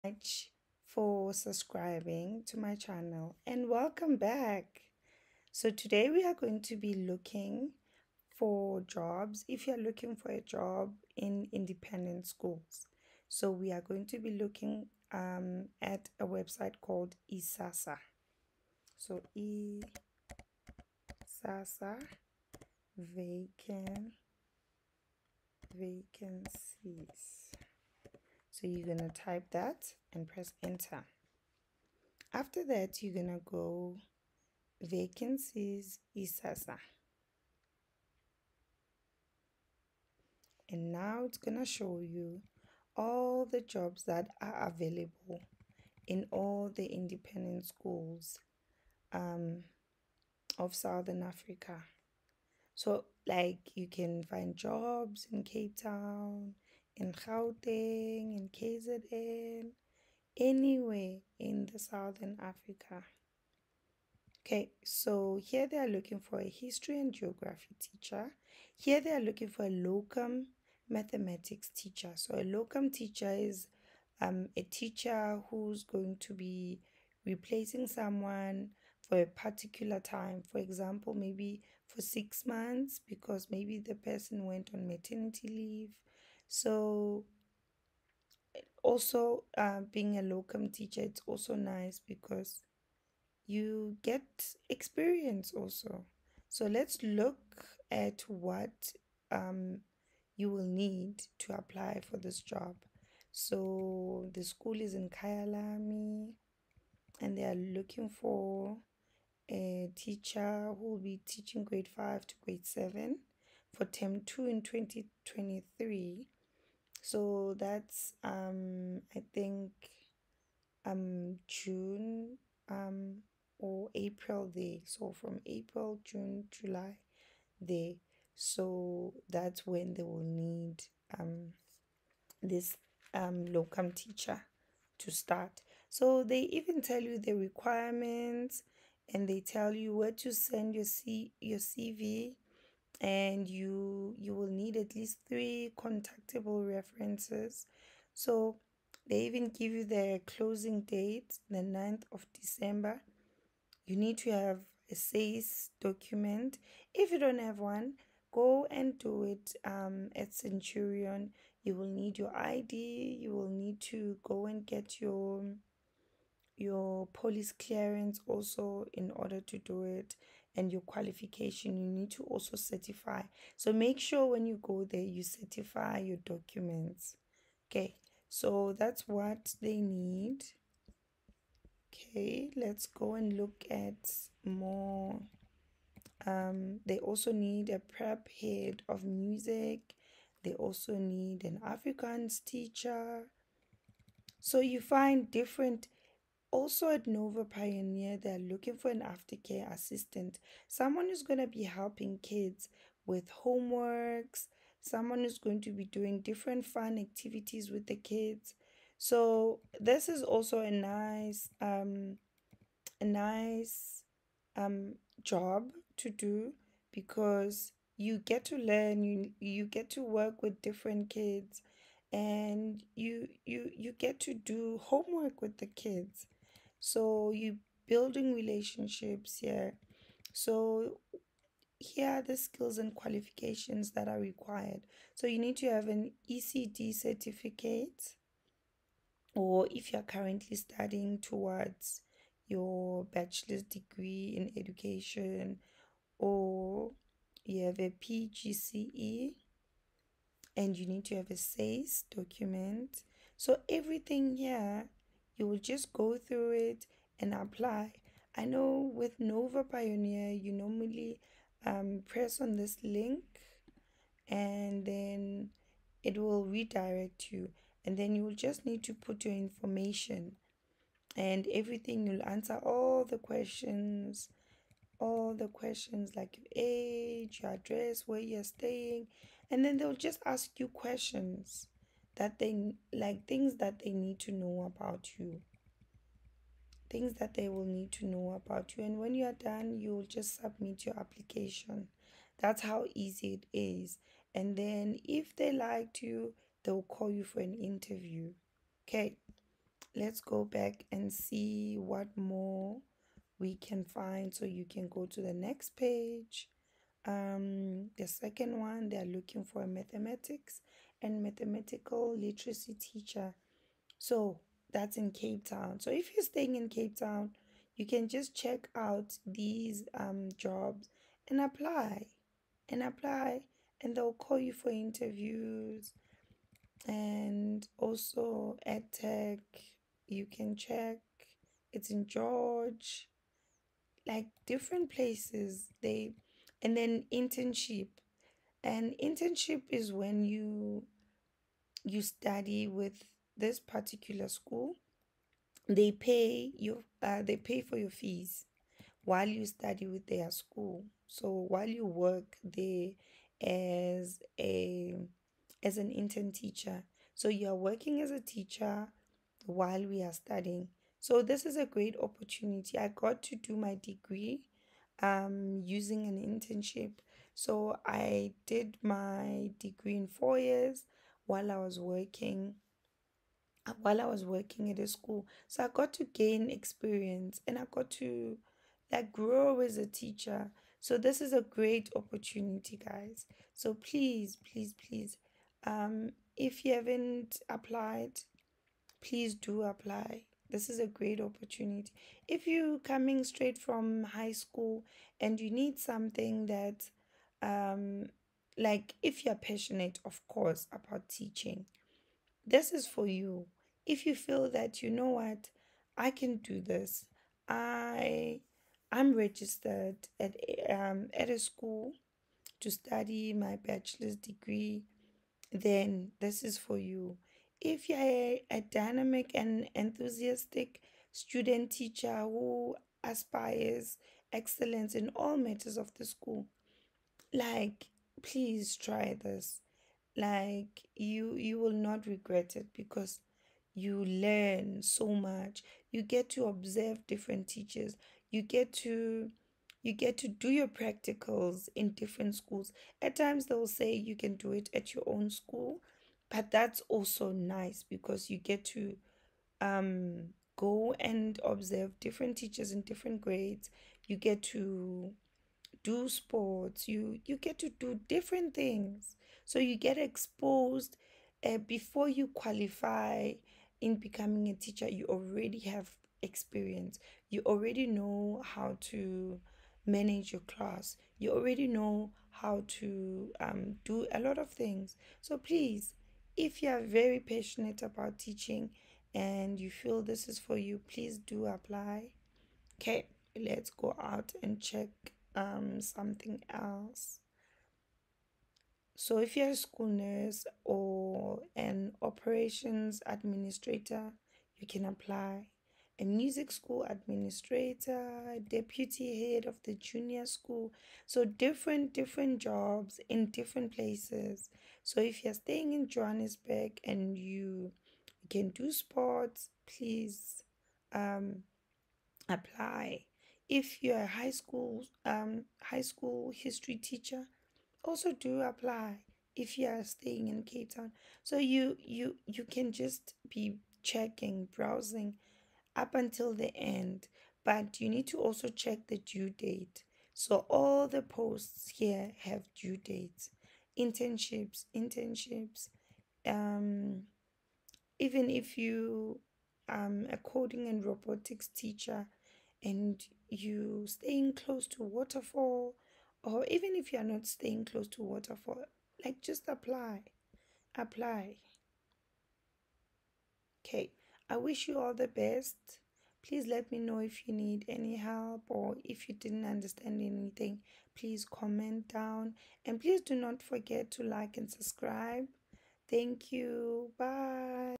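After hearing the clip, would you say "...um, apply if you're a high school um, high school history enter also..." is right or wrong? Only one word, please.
wrong.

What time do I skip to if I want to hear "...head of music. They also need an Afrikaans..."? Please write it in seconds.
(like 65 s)
188 s.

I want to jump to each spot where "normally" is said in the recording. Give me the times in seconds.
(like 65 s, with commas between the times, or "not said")
260 s.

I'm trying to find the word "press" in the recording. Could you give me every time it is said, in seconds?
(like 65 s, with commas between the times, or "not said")
30 s, 262 s.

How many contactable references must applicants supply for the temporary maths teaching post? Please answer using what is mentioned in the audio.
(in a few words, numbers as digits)
3.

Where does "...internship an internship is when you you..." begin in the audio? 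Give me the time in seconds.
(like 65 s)
337 s.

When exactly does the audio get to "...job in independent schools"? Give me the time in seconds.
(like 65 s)
10 s.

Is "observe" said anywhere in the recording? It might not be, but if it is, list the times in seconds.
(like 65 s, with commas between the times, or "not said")
436 s, 451 s.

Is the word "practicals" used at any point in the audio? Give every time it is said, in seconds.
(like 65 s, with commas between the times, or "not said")
440 s.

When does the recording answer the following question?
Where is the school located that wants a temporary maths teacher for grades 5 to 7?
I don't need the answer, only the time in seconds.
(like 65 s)
105 s.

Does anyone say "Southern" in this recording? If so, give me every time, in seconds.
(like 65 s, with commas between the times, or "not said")
50 s, 61 s.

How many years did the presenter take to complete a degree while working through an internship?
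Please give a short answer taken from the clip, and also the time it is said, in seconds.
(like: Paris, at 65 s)
4, at 370 s.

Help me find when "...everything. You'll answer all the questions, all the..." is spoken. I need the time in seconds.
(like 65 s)
271 s.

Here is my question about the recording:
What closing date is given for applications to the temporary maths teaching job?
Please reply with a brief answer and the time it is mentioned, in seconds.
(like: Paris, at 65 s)
9th of December, at 151 s.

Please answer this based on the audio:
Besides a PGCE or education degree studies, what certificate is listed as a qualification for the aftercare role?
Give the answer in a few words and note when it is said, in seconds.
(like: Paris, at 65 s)
ECD certificate, at 236 s.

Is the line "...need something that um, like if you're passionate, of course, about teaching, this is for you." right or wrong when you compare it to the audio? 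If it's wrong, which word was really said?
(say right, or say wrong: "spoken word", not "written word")
right.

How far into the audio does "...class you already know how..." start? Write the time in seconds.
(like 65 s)
470 s.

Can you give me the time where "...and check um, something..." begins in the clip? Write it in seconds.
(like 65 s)
484 s.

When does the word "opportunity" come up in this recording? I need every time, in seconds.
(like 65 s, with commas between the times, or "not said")
362 s, 381 s, 391 s.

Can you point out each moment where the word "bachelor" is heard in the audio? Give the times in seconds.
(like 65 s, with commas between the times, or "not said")
243 s, 413 s.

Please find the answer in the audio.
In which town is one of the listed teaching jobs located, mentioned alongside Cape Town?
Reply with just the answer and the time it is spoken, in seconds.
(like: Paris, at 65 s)
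George, at 332 s.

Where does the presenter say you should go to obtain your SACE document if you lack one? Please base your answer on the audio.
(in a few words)
Centurion.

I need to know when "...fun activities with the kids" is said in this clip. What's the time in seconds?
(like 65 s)
206 s.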